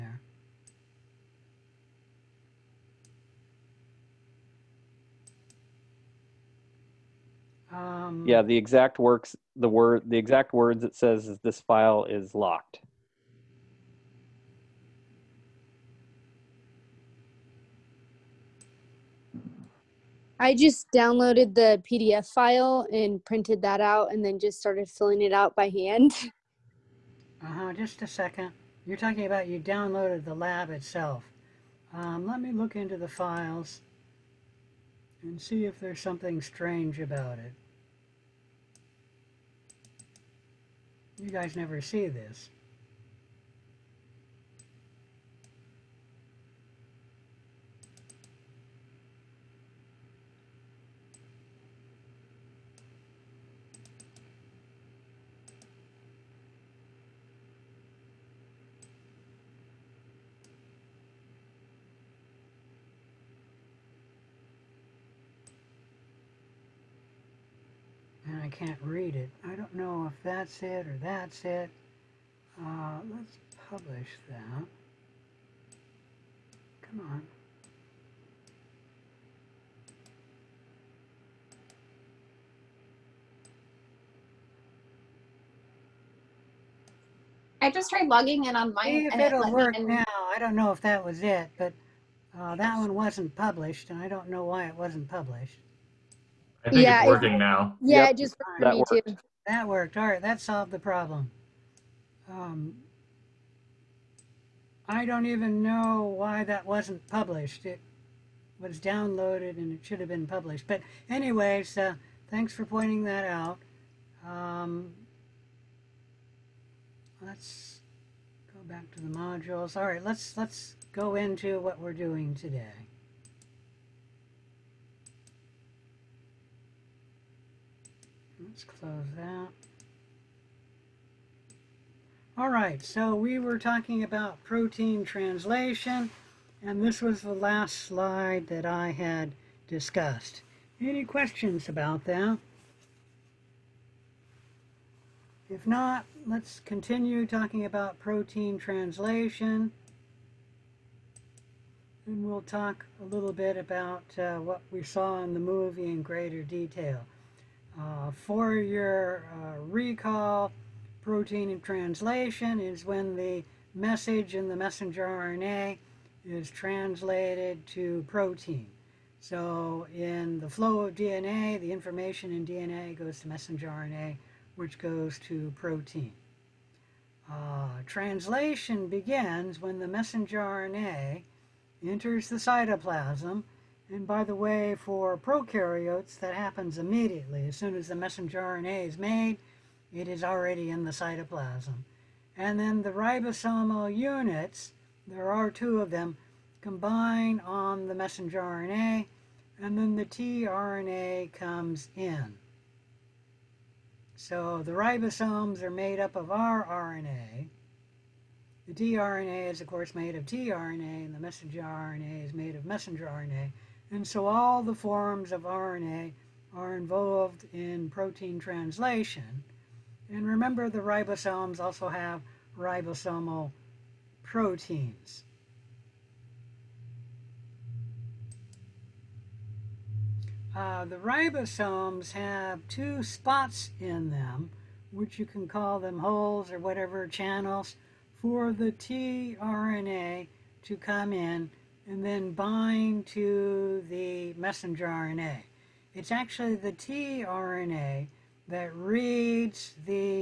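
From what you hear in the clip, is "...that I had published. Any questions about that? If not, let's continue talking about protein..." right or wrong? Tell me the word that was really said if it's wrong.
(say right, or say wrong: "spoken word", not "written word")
wrong: "discussed", not "published".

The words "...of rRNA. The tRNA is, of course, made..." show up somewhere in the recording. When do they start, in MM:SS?
03:26.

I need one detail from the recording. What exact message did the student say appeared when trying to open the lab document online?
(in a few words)
This file is locked.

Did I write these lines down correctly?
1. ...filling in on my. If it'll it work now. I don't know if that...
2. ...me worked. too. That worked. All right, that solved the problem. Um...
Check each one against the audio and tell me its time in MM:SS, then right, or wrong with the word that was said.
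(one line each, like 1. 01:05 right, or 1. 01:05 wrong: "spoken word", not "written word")
1. 01:28 wrong: "logging", not "filling"
2. 01:38 right.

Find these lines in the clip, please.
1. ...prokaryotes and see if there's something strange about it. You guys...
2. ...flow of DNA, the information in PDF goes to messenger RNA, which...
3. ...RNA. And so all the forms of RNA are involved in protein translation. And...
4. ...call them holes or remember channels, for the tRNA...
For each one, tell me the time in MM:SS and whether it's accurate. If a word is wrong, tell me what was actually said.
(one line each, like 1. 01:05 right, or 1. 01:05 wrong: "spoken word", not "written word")
1. 00:33 wrong: "files", not "prokaryotes"
2. 02:50 wrong: "DNA", not "PDF"
3. 03:33 right
4. 03:55 wrong: "whatever", not "remember".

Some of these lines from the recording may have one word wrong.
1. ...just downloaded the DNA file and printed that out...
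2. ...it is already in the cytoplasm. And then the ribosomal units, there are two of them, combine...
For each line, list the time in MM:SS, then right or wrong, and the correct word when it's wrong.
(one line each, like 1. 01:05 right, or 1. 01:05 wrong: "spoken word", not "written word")
1. 00:20 wrong: "PDF", not "DNA"
2. 03:09 right.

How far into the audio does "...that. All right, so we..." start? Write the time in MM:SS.
02:09.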